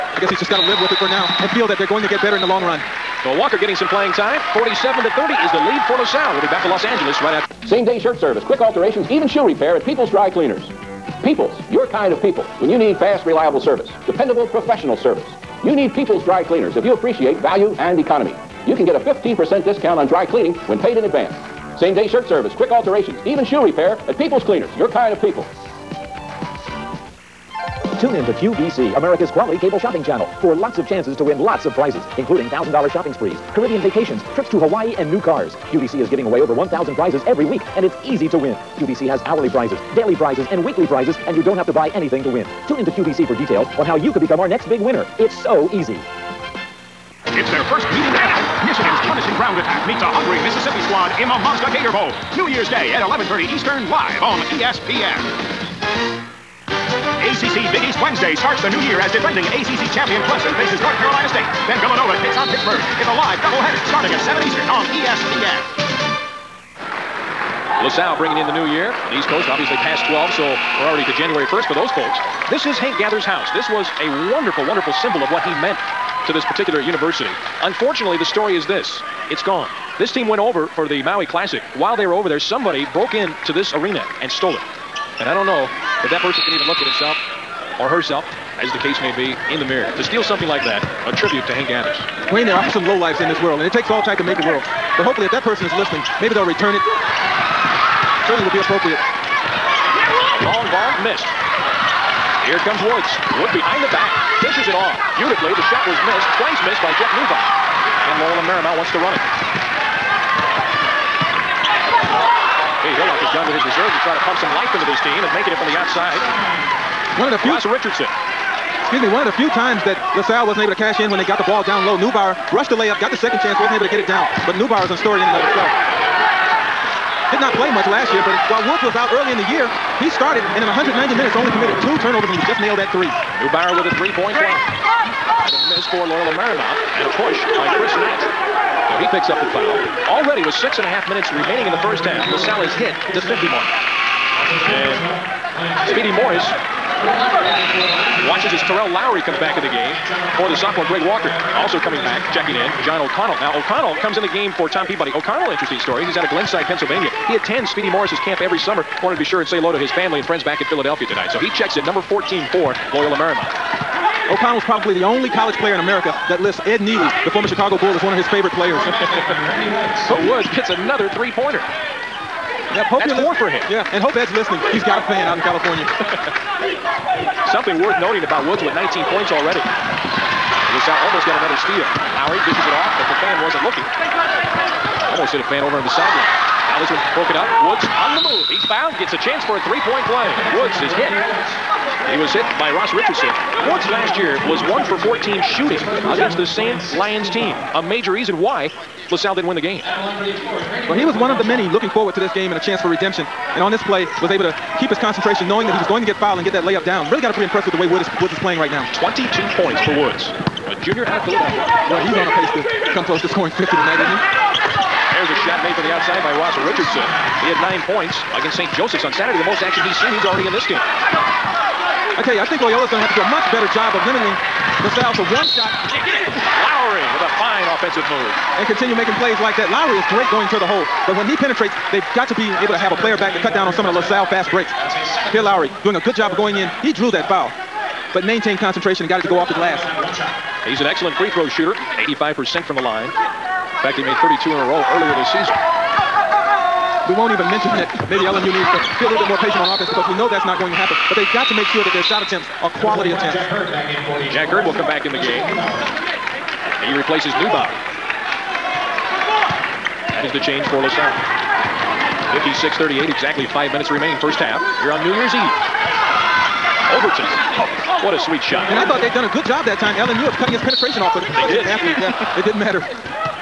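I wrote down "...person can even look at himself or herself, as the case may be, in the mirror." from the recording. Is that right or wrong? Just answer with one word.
right.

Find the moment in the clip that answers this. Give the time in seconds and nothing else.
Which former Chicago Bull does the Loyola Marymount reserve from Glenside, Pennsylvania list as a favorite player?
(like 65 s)
166 s.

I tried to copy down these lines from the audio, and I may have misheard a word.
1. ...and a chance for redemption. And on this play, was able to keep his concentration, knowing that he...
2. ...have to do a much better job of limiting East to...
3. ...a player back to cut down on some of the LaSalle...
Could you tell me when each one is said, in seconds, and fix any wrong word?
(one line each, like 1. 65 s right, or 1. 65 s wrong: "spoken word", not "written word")
1. 202 s right
2. 223 s wrong: "LaSalle", not "East"
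3. 232 s right.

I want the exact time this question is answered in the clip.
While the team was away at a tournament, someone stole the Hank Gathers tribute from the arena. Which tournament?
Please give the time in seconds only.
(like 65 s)
81 s.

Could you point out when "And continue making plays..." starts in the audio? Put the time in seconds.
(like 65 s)
228 s.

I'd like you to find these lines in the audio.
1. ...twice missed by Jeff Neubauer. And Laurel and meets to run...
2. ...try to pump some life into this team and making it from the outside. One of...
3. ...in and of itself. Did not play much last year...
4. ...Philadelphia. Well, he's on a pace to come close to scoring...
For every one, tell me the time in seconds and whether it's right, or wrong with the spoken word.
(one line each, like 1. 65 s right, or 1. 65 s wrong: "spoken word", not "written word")
1. 106 s wrong: "wants", not "meets"
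2. 114 s right
3. 125 s right
4. 211 s right.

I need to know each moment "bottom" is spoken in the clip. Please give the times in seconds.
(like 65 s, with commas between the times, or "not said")
not said.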